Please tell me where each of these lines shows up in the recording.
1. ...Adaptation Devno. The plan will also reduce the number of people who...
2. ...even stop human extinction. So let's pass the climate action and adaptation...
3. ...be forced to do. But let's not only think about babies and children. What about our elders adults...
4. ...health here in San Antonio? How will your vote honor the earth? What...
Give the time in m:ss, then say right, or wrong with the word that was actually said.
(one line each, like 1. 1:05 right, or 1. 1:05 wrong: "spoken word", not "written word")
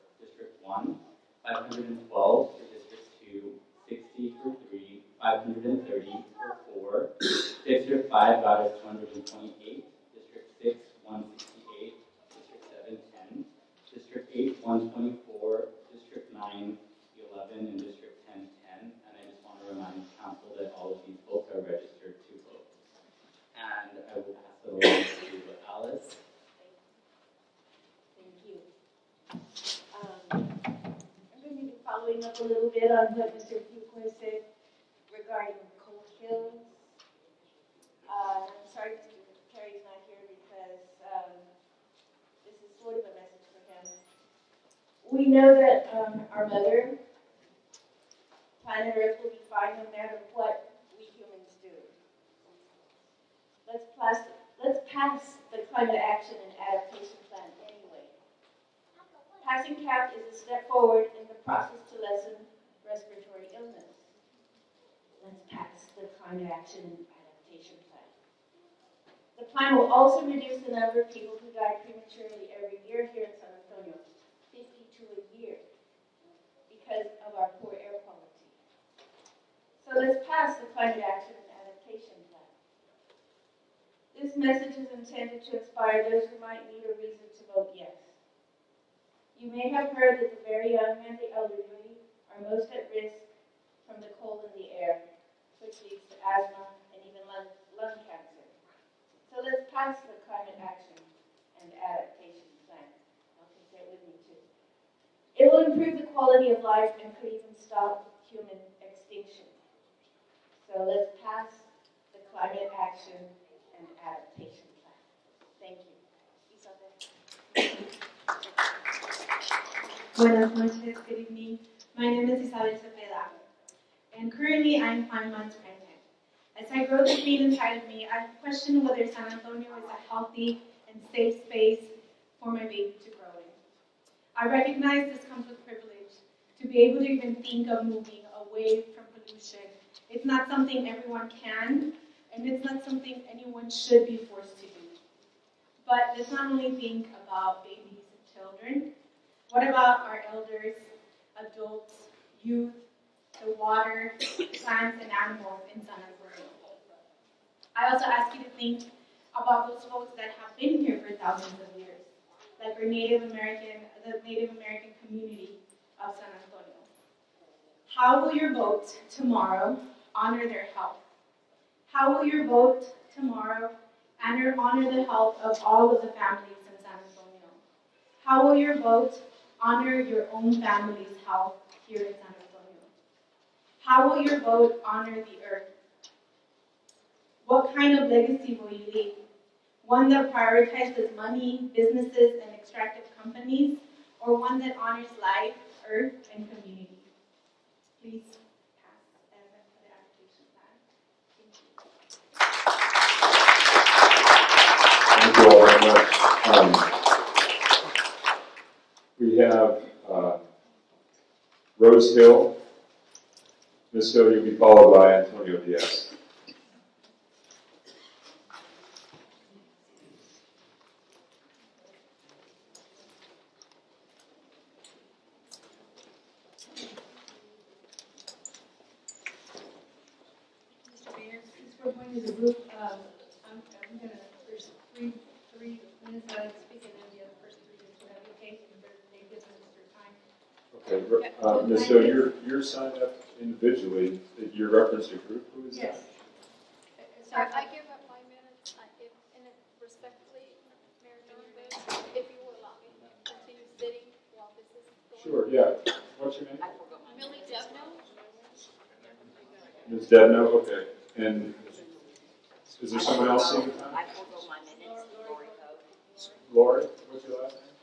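1. 1:07 wrong: "Plan", not "Devno"
2. 1:47 right
3. 2:24 right
4. 3:01 right.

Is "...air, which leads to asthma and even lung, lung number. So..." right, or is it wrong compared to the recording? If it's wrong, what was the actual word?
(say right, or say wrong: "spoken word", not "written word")
wrong: "cancer", not "number".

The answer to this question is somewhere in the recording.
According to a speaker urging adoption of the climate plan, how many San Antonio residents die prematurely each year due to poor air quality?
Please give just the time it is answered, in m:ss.
1:14.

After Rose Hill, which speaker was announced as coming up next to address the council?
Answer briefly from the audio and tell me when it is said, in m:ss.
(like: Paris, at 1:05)
Antonio Diaz, at 3:35.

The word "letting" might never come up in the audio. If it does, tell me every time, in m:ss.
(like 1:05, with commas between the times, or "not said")
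not said.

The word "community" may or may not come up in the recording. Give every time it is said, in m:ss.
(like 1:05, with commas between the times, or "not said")
2:45, 3:16.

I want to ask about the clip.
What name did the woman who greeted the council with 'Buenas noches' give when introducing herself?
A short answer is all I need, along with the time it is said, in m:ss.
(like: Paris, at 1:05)
Isabel Cepeda, at 2:02.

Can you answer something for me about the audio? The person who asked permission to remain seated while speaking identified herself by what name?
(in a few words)
Millie Devno.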